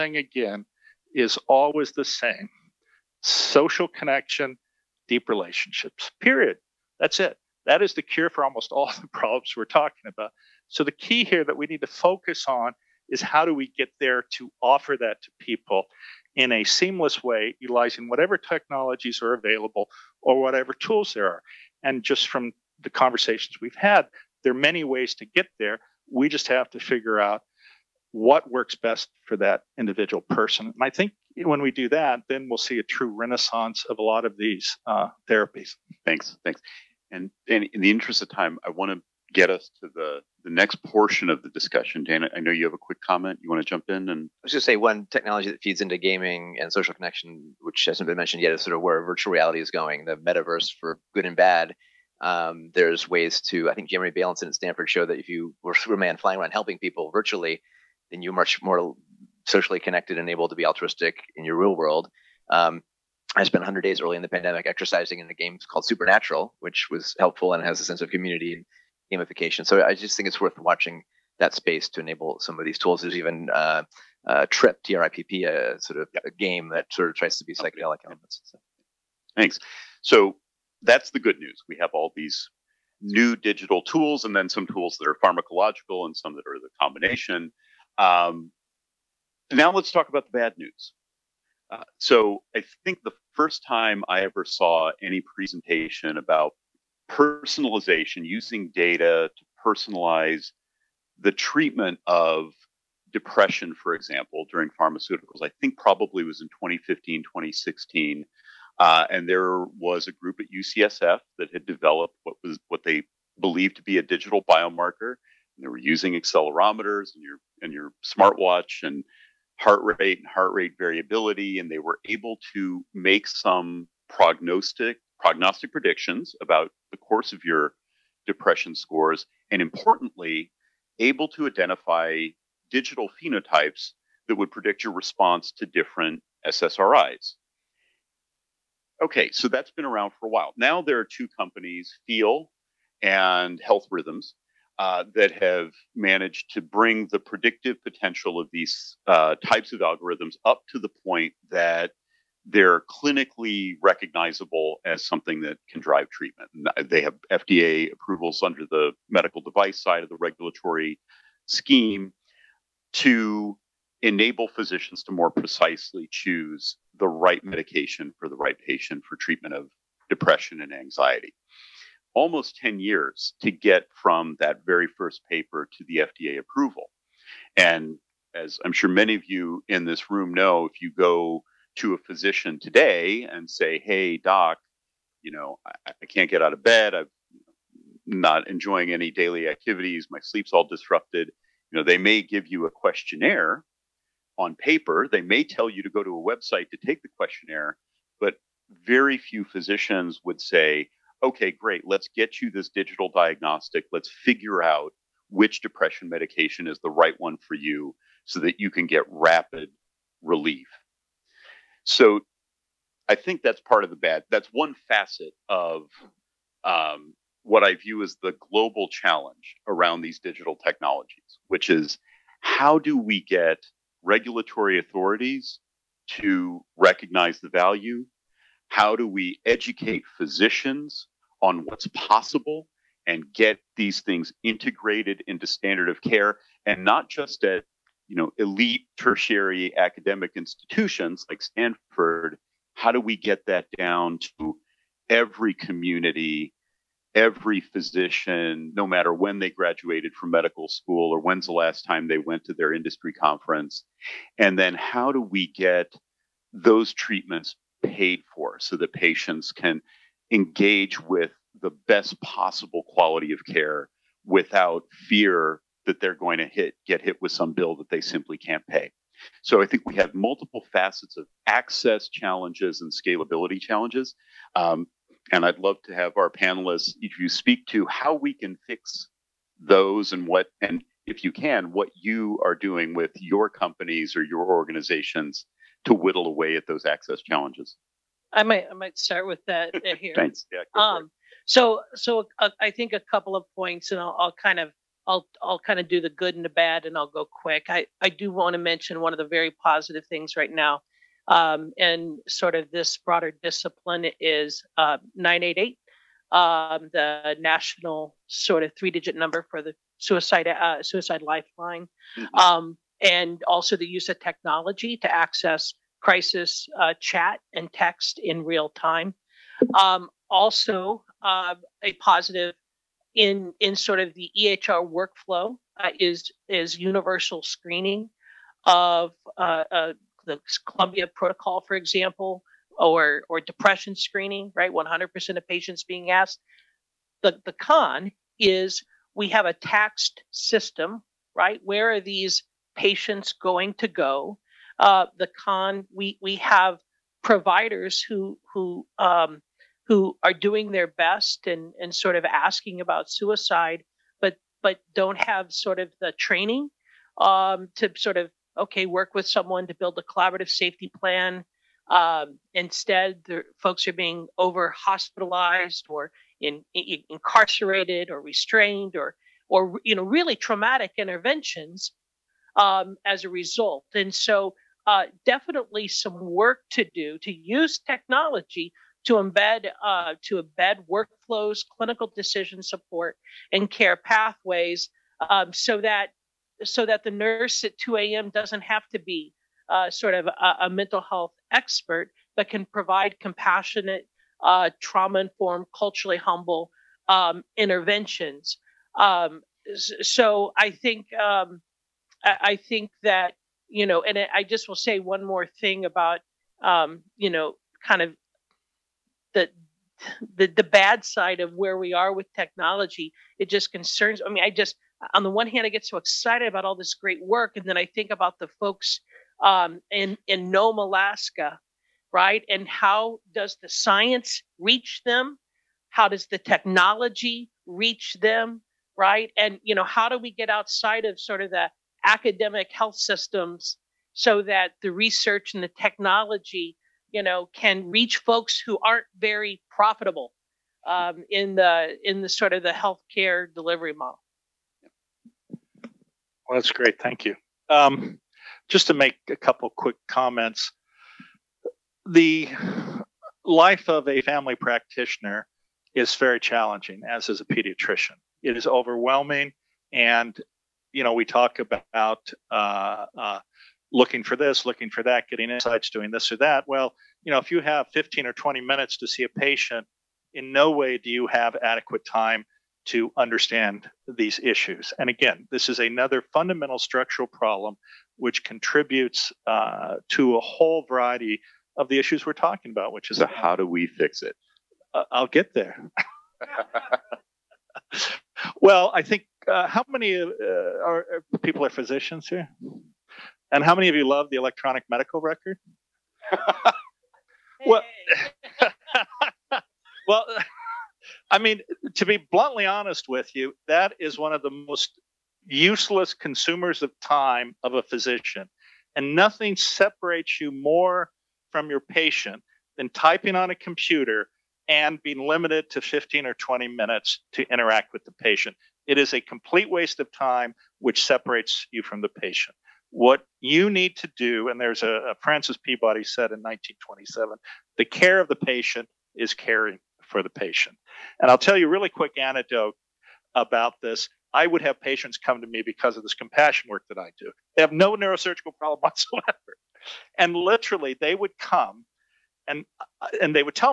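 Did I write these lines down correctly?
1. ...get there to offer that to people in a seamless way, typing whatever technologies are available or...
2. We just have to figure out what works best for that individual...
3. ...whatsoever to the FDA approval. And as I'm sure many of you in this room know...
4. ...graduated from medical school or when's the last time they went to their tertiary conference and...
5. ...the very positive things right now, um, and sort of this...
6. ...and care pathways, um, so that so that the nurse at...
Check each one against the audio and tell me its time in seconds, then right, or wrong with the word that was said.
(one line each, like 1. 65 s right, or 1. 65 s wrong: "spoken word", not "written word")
1. 13 s wrong: "utilizing", not "typing"
2. 26 s right
3. 175 s wrong: "paper", not "whatsoever"
4. 249 s wrong: "industry", not "tertiary"
5. 299 s right
6. 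383 s right.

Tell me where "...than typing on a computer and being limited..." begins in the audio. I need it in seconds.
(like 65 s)
512 s.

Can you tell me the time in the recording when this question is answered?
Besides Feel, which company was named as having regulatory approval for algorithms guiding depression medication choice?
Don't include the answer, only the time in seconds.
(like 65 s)
143 s.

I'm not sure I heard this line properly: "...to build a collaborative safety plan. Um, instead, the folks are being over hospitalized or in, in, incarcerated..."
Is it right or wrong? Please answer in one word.
right.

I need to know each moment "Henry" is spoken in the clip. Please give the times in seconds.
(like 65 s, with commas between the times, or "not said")
not said.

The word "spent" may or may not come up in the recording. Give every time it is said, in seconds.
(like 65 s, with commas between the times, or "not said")
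63 s.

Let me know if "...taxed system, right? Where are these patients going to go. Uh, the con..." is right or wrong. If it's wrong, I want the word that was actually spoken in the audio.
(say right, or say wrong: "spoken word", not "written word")
right.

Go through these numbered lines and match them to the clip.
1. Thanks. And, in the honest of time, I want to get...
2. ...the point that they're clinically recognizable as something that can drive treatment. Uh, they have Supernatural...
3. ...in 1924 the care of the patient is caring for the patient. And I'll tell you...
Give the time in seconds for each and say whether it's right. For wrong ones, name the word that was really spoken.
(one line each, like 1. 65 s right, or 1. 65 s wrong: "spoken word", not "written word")
1. 36 s wrong: "interest", not "honest"
2. 150 s wrong: "FDA", not "Supernatural"
3. 526 s wrong: "1927", not "1924".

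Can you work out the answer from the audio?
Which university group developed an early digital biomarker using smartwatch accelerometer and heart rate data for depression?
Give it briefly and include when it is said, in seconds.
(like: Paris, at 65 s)
UCSF, at 110 s.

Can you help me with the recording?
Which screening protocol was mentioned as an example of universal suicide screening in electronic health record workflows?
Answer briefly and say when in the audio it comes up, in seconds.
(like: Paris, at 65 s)
Columbia Protocol, at 330 s.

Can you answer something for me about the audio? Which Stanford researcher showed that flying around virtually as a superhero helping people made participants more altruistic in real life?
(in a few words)
Jeremy Bailenson.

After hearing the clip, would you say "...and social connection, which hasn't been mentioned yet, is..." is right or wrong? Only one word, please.
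right.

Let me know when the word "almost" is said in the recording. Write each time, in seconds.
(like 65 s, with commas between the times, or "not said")
8 s, 172 s.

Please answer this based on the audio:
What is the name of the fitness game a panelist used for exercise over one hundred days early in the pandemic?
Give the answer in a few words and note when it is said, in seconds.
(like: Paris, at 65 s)
Supernatural, at 65 s.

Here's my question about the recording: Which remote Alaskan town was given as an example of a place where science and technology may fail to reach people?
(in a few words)
Nome.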